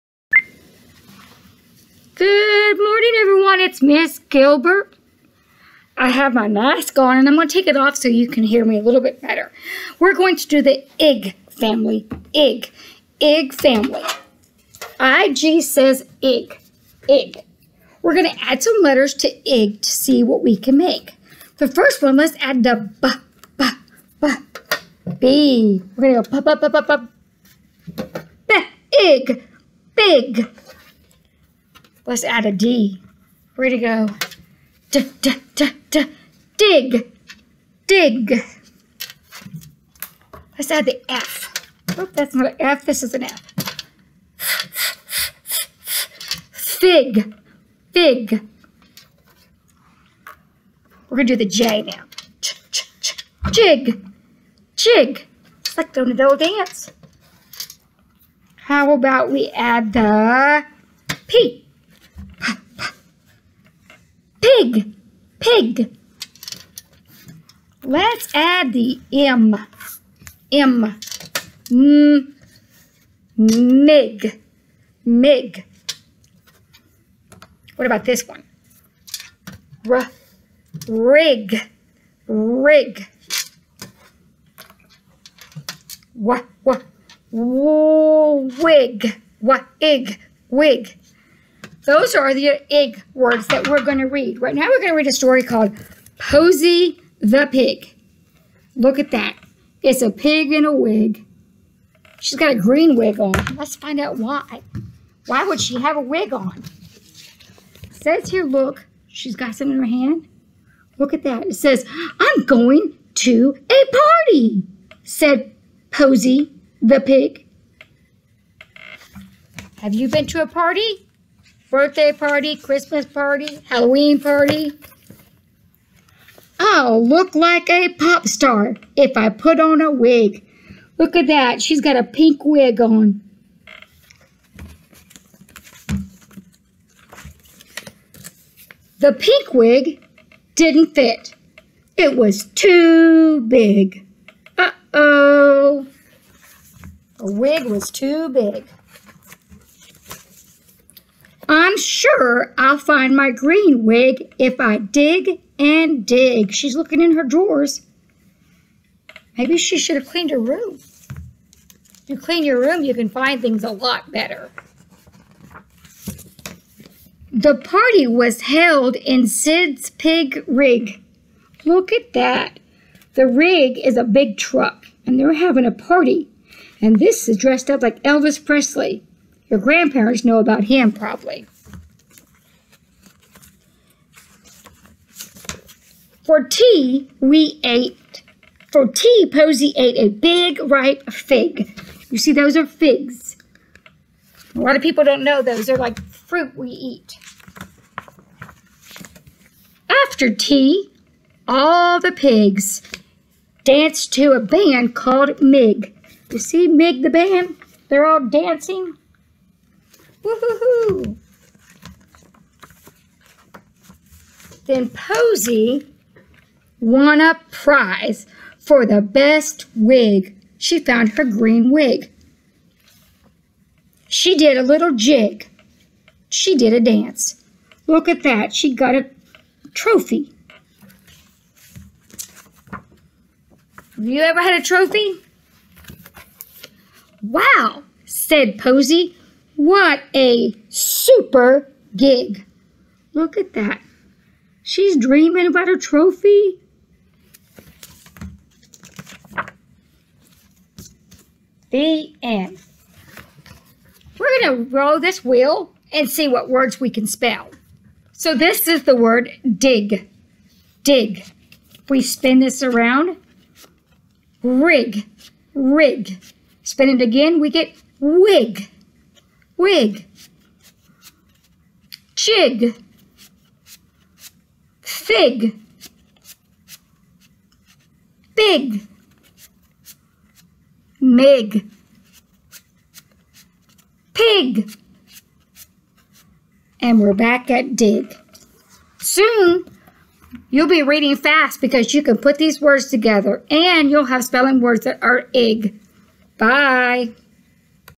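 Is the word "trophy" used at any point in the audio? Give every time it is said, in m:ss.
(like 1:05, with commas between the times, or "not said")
3:49, 3:54, 4:05.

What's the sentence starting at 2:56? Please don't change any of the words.
And this is dressed up like Elvis Presley.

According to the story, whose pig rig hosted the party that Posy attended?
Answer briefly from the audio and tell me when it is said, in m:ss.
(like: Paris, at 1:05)
Sid's, at 2:49.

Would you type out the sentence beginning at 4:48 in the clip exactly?
Soon, you'll be reading fast because you can put these words together and you'll have spelling words that are ig.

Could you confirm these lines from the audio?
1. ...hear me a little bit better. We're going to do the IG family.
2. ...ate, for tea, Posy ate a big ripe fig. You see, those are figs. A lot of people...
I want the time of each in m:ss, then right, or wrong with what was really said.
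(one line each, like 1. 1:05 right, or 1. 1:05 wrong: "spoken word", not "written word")
1. 0:08 right
2. 3:07 right.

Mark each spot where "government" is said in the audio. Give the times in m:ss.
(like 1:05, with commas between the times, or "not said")
not said.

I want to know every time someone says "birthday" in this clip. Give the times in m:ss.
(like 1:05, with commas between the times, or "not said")
2:01.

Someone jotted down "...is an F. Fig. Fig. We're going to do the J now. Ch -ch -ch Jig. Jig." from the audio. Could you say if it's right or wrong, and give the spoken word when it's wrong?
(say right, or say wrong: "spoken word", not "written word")
right.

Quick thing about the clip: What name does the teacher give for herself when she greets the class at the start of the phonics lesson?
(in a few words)
Miss Gilbert.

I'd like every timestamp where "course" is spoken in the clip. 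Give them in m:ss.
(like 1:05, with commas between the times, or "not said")
not said.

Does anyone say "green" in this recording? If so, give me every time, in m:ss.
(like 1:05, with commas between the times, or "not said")
1:42, 2:33, 3:41.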